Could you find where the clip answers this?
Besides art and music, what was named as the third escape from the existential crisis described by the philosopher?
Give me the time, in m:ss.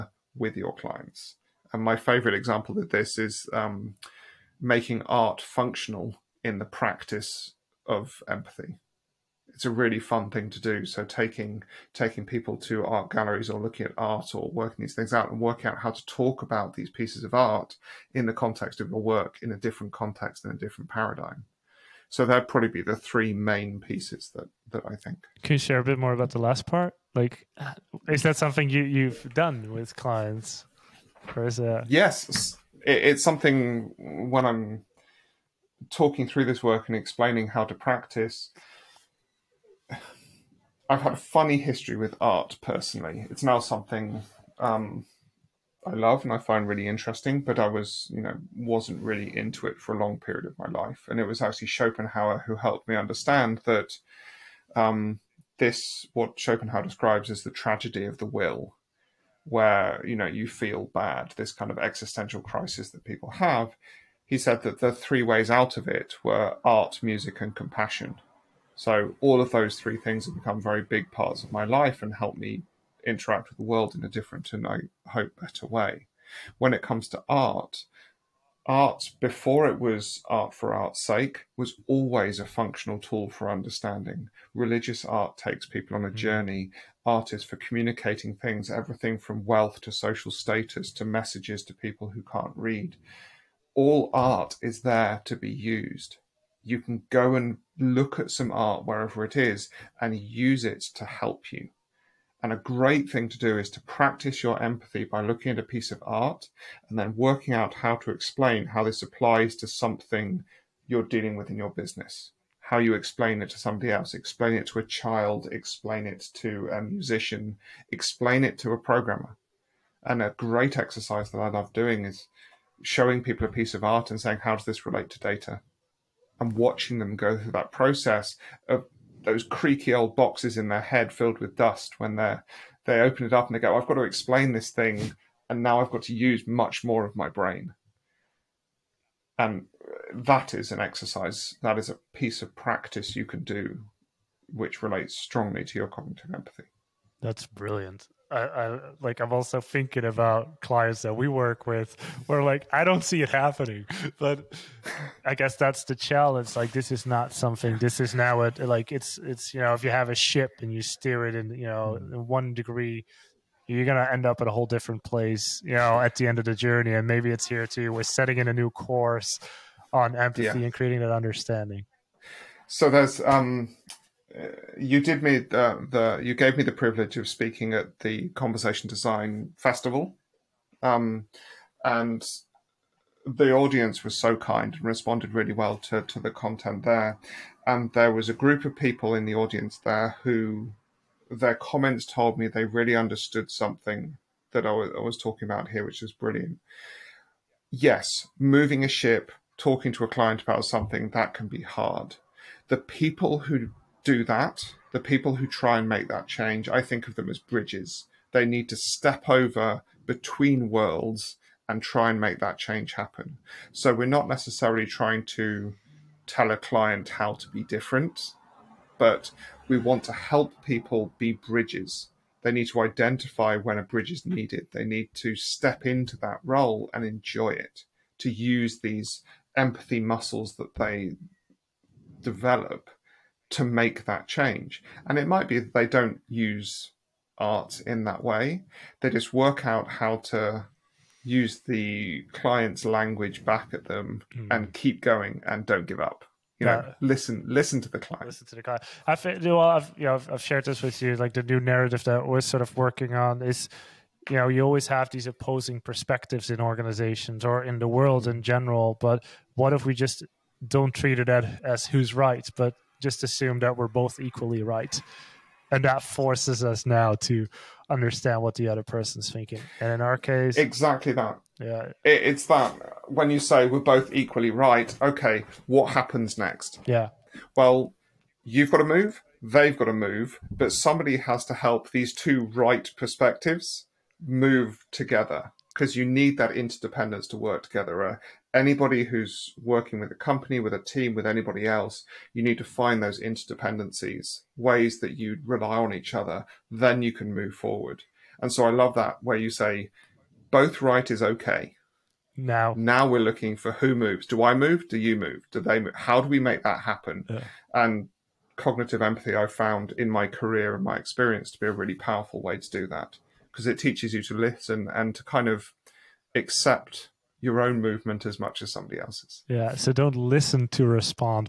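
1:07.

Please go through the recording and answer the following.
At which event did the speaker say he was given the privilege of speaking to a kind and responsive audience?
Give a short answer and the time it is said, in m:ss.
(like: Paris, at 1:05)
Conversation Design Festival, at 2:58.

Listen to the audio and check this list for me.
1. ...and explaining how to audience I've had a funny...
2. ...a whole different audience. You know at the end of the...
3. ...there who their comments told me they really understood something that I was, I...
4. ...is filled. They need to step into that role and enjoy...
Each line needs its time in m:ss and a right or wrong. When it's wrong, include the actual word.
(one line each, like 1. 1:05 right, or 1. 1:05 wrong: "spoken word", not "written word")
1. 0:36 wrong: "practice", not "audience"
2. 2:44 wrong: "place", not "audience"
3. 3:09 right
4. 3:44 wrong: "needed", not "filled".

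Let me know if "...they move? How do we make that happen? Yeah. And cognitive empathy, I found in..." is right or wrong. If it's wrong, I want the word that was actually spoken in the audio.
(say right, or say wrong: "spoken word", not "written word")
right.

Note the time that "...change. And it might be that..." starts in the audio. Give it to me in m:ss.
3:54.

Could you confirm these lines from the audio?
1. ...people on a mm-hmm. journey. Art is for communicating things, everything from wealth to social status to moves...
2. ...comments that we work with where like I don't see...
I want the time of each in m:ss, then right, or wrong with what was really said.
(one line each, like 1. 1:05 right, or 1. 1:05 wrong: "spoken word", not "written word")
1. 1:25 wrong: "messages", not "moves"
2. 2:30 wrong: "clients", not "comments".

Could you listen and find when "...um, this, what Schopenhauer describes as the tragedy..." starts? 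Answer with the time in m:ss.
0:54.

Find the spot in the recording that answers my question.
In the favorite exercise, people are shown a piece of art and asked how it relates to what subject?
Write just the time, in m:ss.
2:05.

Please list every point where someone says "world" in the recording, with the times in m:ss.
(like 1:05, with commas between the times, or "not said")
1:13, 3:30, 4:17.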